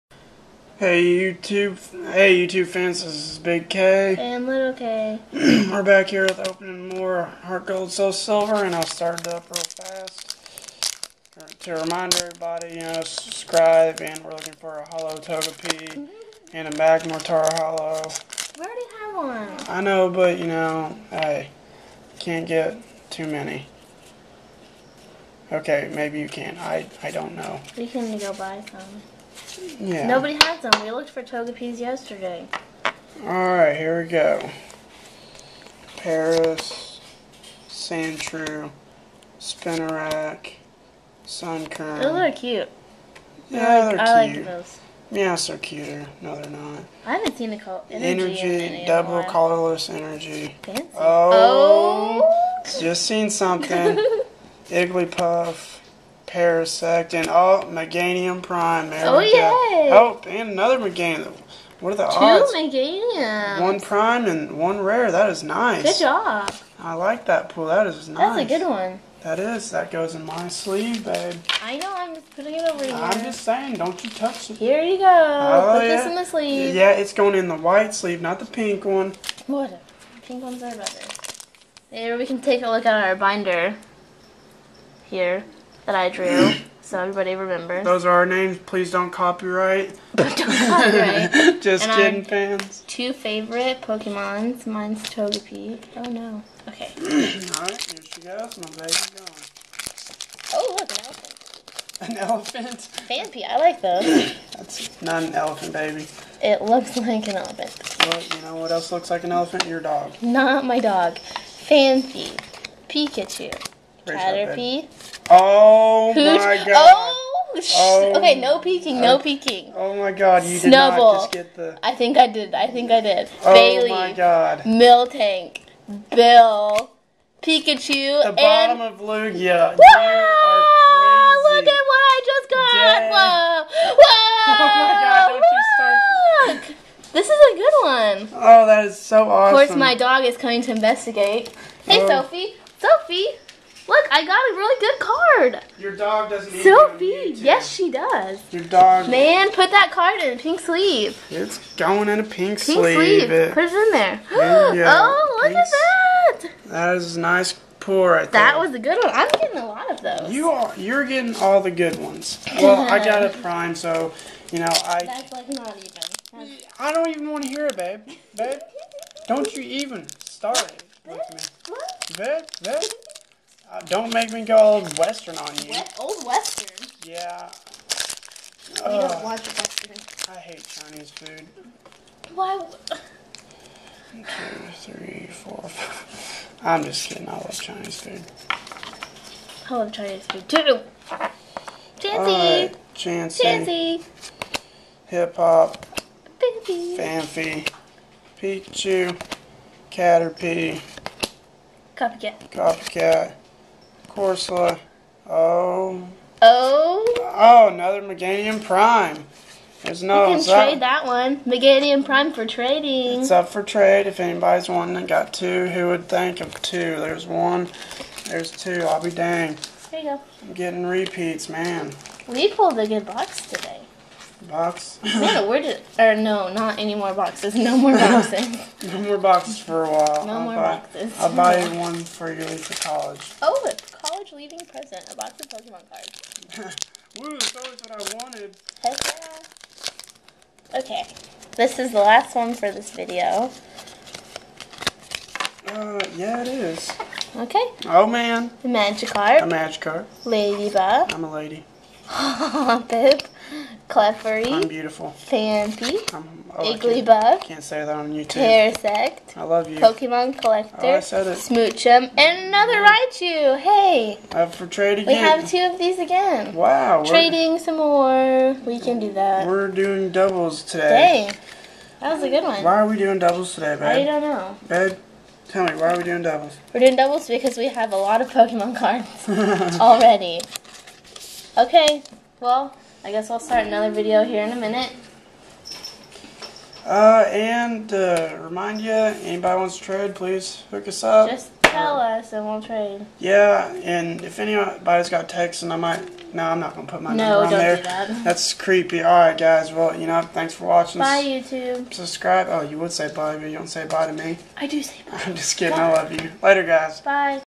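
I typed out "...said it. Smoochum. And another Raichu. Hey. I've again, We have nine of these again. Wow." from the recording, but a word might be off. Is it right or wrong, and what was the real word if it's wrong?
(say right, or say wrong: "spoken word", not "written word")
wrong: "two", not "nine".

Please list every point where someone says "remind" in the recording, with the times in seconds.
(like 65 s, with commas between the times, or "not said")
11 s, 288 s.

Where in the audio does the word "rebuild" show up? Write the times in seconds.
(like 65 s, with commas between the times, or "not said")
not said.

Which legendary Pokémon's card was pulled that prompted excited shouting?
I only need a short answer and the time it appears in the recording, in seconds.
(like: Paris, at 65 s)
Lugia, at 128 s.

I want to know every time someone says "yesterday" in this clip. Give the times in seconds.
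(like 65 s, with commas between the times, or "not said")
31 s.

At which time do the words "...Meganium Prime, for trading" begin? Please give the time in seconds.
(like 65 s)
211 s.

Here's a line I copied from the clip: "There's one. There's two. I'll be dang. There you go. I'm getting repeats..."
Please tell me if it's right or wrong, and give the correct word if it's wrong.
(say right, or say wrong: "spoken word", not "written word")
right.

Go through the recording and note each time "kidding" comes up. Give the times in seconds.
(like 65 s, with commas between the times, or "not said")
92 s, 187 s, 305 s.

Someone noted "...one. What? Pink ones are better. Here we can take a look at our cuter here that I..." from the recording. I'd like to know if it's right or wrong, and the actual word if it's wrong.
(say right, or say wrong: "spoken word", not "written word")
wrong: "binder", not "cuter".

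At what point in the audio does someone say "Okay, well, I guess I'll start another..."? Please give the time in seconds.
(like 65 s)
281 s.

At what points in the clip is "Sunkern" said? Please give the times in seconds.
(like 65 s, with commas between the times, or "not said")
41 s.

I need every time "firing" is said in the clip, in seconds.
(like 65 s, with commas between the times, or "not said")
not said.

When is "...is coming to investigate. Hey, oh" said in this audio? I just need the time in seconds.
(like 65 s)
140 s.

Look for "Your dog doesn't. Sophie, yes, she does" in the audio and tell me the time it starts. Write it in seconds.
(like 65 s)
145 s.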